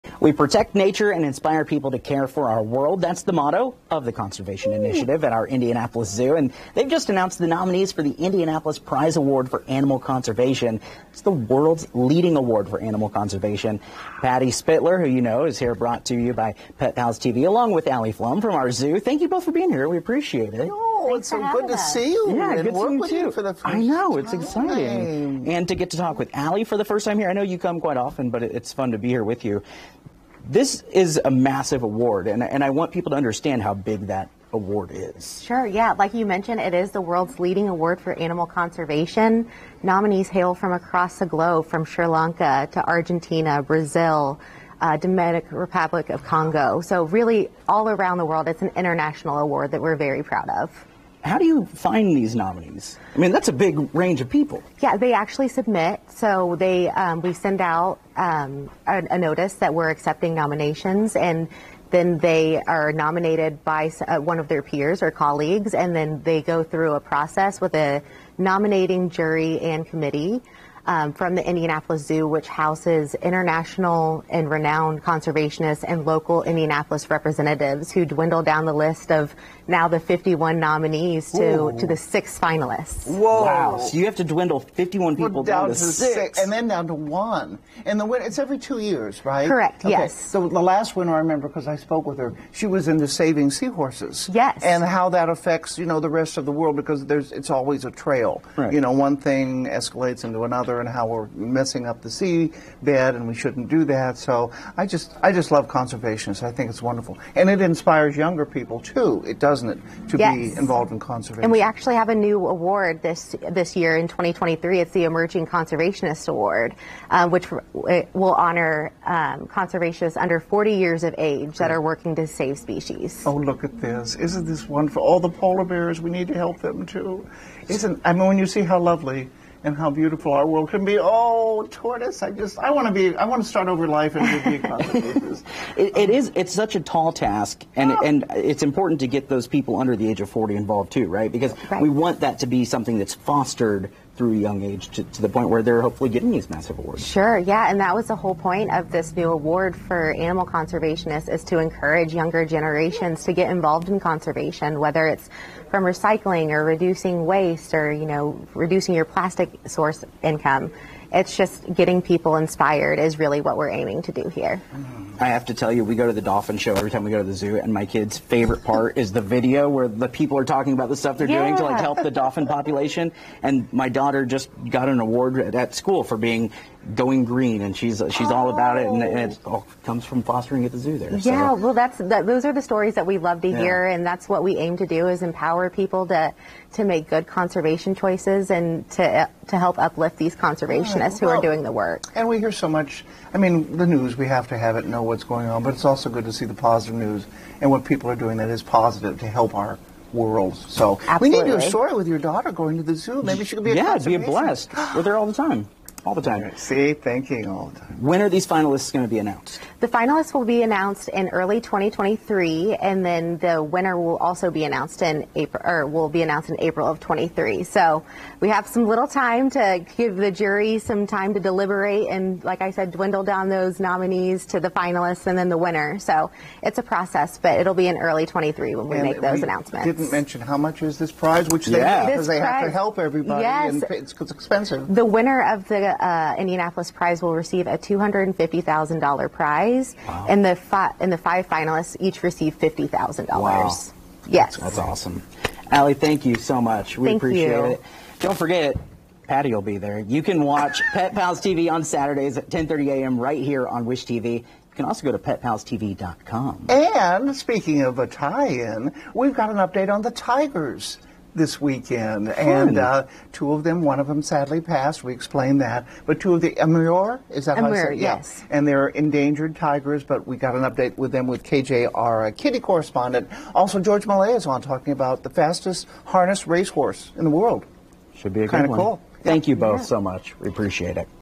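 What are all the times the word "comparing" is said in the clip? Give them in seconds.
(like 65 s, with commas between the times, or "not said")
not said.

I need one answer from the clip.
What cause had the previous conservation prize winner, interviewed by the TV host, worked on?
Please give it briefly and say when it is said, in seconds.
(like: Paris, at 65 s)
Saving seahorses, at 93 s.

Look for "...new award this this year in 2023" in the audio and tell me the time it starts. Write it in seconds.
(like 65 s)
112 s.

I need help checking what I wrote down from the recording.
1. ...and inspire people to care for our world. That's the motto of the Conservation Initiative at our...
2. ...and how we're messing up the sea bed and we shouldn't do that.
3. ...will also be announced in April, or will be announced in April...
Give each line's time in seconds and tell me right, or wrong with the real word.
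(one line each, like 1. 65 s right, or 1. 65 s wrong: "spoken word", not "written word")
1. 1 s right
2. 100 s right
3. 213 s right.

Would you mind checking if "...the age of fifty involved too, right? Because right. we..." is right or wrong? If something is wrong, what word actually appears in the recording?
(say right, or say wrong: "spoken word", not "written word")
wrong: "forty", not "fifty".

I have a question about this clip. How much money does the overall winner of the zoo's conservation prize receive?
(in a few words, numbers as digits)
$250,000.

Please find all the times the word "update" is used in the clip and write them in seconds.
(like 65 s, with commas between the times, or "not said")
259 s, 270 s.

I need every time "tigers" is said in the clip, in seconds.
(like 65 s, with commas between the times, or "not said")
260 s, 269 s.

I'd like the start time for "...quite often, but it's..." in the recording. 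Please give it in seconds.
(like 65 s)
27 s.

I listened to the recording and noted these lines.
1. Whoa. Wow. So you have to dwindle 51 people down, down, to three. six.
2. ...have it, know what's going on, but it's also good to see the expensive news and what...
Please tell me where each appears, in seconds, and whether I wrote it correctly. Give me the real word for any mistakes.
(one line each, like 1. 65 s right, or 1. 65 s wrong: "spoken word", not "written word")
1. 83 s wrong: "six", not "three"
2. 194 s wrong: "positive", not "expensive".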